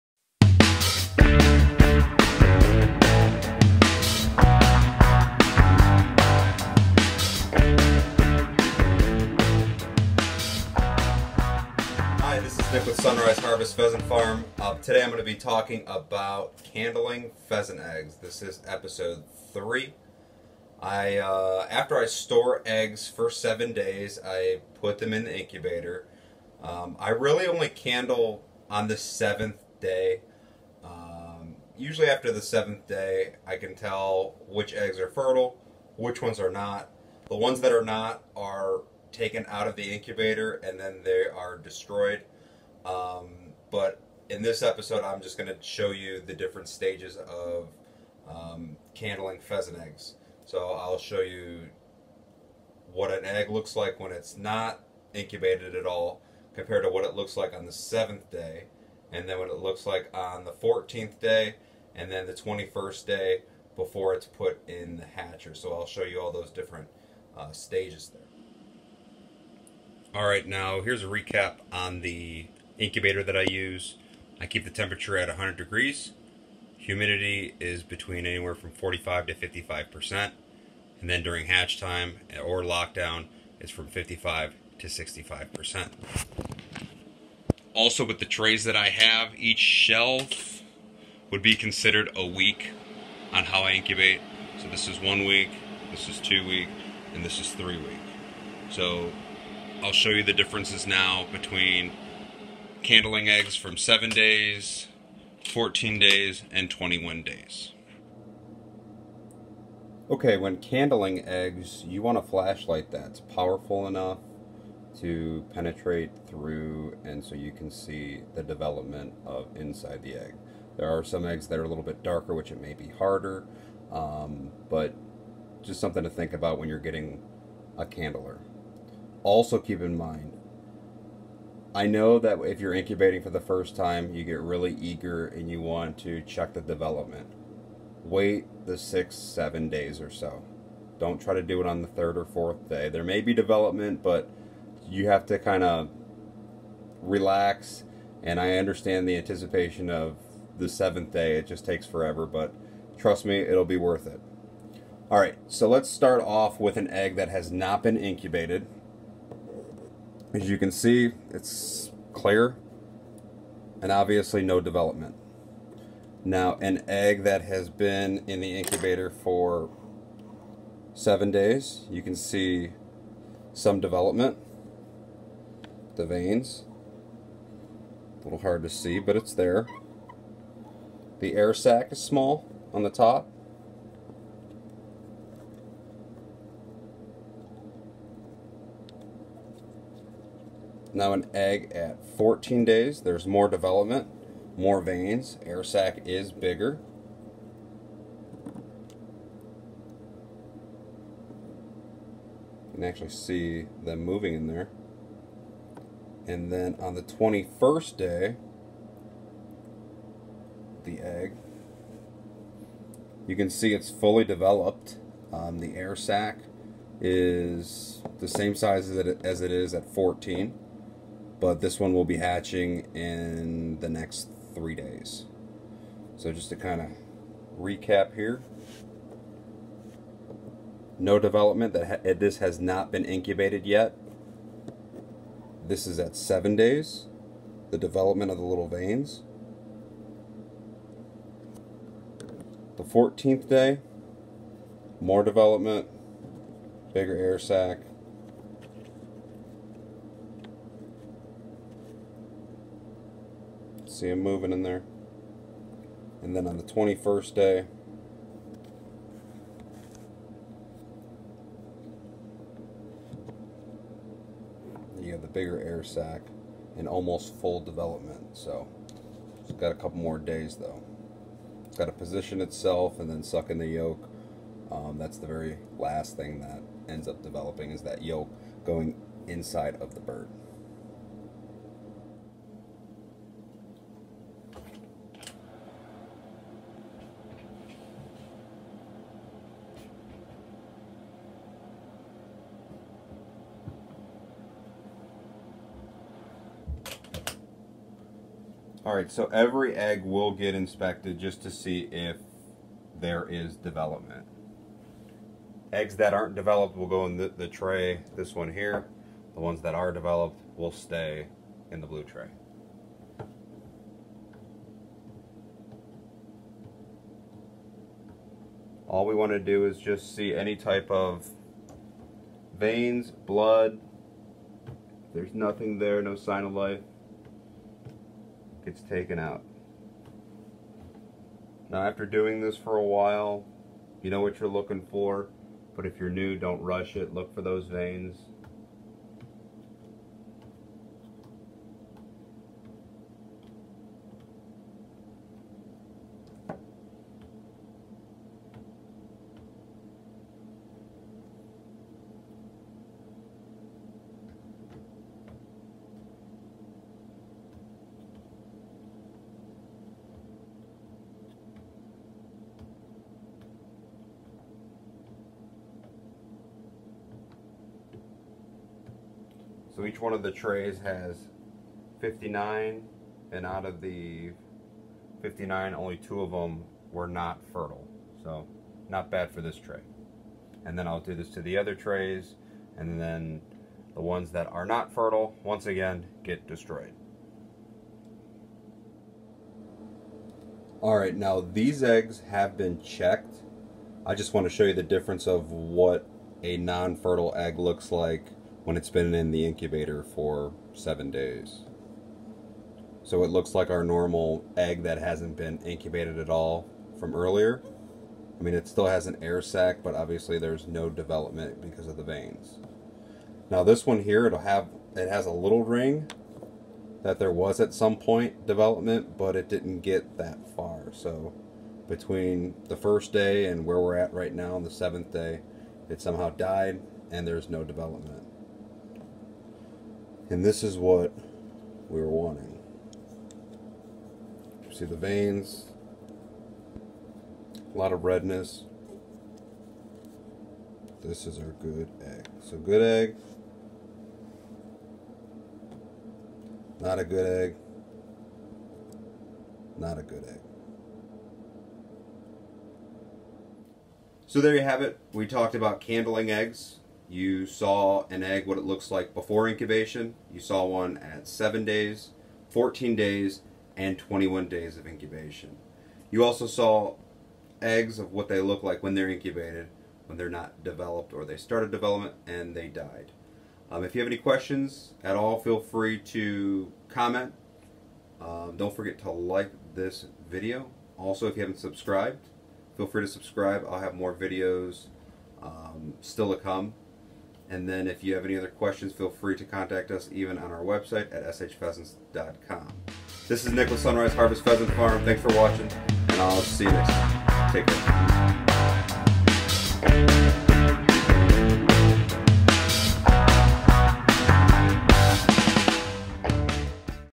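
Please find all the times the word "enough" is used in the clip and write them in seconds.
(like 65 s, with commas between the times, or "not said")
113 s.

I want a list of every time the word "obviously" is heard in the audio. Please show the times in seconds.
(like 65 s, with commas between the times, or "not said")
163 s, 409 s.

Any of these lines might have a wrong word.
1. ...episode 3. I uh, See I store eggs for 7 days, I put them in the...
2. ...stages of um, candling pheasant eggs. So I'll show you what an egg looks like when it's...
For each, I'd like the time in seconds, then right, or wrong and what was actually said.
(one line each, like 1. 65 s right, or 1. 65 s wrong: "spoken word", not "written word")
1. 18 s wrong: "After", not "See"
2. 46 s right.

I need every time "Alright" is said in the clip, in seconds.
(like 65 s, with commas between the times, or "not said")
298 s, 390 s.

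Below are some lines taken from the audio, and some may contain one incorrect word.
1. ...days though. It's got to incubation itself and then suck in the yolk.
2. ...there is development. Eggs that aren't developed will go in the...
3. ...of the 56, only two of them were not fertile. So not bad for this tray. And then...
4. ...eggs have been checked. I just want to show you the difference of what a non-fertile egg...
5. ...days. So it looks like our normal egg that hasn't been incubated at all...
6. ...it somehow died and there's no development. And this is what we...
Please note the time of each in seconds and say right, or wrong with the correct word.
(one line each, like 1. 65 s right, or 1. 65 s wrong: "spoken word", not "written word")
1. 270 s wrong: "position", not "incubation"
2. 302 s right
3. 373 s wrong: "59", not "56"
4. 391 s right
5. 401 s right
6. 425 s right.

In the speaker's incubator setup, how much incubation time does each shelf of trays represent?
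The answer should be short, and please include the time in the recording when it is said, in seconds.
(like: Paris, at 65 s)
a week, at 92 s.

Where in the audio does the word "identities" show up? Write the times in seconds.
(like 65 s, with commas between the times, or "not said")
not said.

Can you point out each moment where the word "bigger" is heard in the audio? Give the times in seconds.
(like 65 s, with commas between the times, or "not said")
196 s, 246 s, 265 s.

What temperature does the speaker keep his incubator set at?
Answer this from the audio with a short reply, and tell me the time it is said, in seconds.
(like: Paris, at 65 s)
100 degrees, at 75 s.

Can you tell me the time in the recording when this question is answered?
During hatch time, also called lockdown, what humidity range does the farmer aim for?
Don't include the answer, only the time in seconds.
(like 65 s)
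83 s.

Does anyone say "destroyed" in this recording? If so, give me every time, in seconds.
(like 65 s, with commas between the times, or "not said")
41 s, 386 s.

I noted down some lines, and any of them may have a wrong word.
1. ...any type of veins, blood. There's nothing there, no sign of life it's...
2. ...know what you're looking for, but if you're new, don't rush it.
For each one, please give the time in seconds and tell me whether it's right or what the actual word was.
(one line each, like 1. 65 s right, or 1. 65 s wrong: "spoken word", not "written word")
1. 320 s right
2. 334 s right.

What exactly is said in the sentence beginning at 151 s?
It just takes forever, but trust me, it'll be worth it.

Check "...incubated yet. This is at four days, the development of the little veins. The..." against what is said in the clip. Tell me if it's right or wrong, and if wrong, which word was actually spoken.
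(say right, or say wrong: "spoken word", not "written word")
wrong: "seven", not "four".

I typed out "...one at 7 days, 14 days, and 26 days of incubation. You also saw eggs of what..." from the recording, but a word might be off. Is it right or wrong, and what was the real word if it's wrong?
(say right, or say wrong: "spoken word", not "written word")
wrong: "21", not "26".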